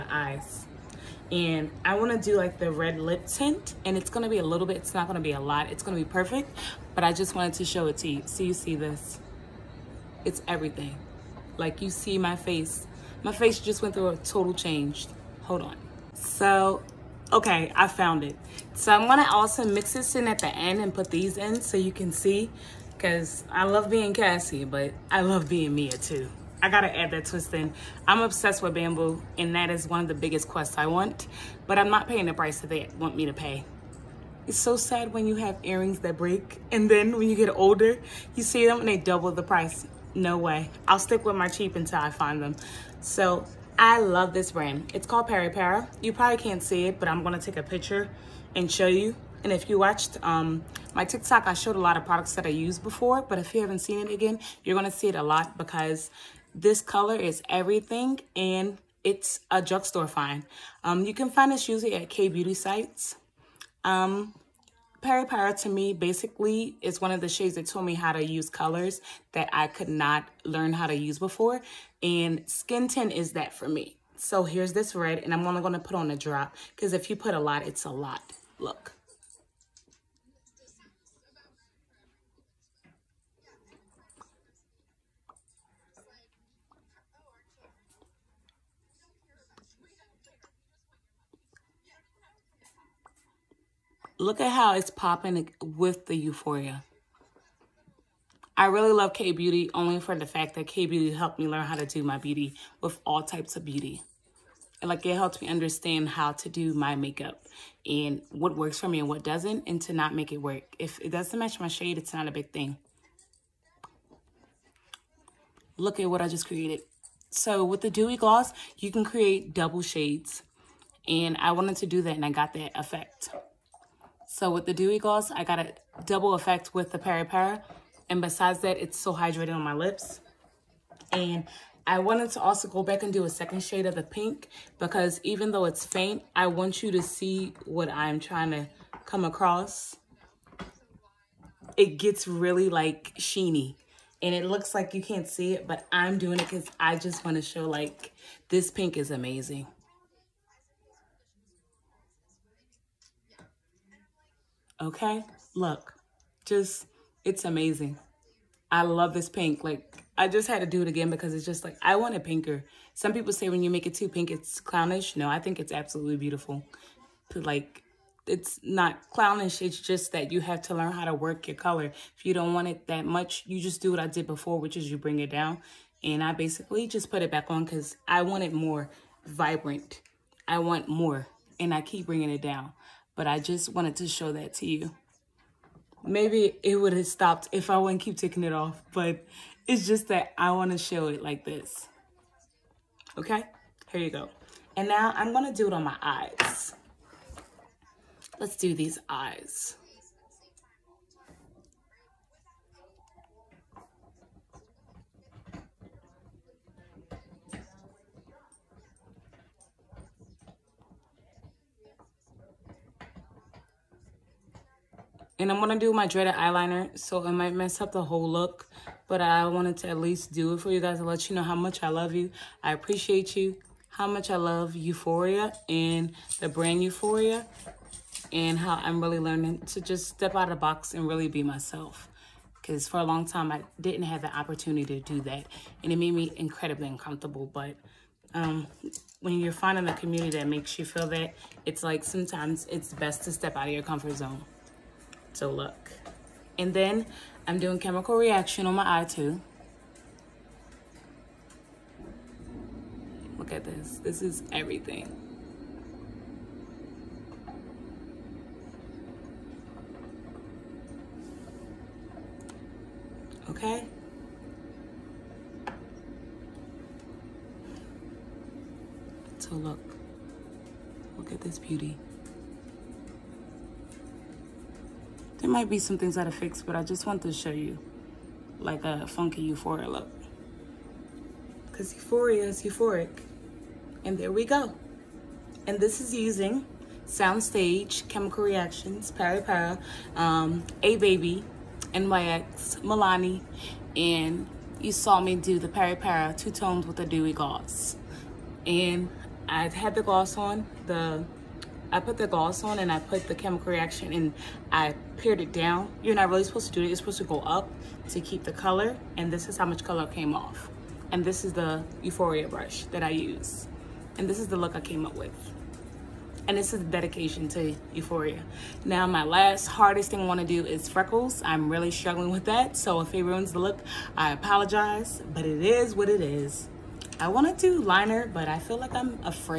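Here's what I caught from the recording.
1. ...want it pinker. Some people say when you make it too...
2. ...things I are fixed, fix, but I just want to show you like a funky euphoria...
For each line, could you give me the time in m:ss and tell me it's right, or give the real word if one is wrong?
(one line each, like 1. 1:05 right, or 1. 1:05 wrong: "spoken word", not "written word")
1. 2:41 right
2. 4:35 right.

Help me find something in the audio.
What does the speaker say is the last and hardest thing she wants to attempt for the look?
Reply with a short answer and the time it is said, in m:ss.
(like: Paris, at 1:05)
freckles, at 5:20.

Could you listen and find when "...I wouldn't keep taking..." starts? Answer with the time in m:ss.
3:07.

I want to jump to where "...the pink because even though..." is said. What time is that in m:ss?
2:13.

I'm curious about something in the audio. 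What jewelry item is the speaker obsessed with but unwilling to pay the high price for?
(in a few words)
bamboo.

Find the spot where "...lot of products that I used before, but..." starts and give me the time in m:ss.
0:51.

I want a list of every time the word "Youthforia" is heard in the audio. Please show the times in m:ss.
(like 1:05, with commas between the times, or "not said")
1:36, 3:46, 5:12.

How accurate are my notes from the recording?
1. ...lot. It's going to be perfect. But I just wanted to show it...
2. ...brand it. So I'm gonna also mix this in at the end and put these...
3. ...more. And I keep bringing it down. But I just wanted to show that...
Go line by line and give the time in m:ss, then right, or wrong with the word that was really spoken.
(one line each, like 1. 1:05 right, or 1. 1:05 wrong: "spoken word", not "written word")
1. 0:05 right
2. 0:17 wrong: "found", not "brand"
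3. 3:00 right.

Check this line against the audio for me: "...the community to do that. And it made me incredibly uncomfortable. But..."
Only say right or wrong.
wrong.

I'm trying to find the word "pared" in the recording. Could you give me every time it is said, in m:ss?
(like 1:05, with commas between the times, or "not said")
5:05.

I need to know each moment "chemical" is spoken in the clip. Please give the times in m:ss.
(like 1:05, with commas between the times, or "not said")
4:07, 4:48, 5:03.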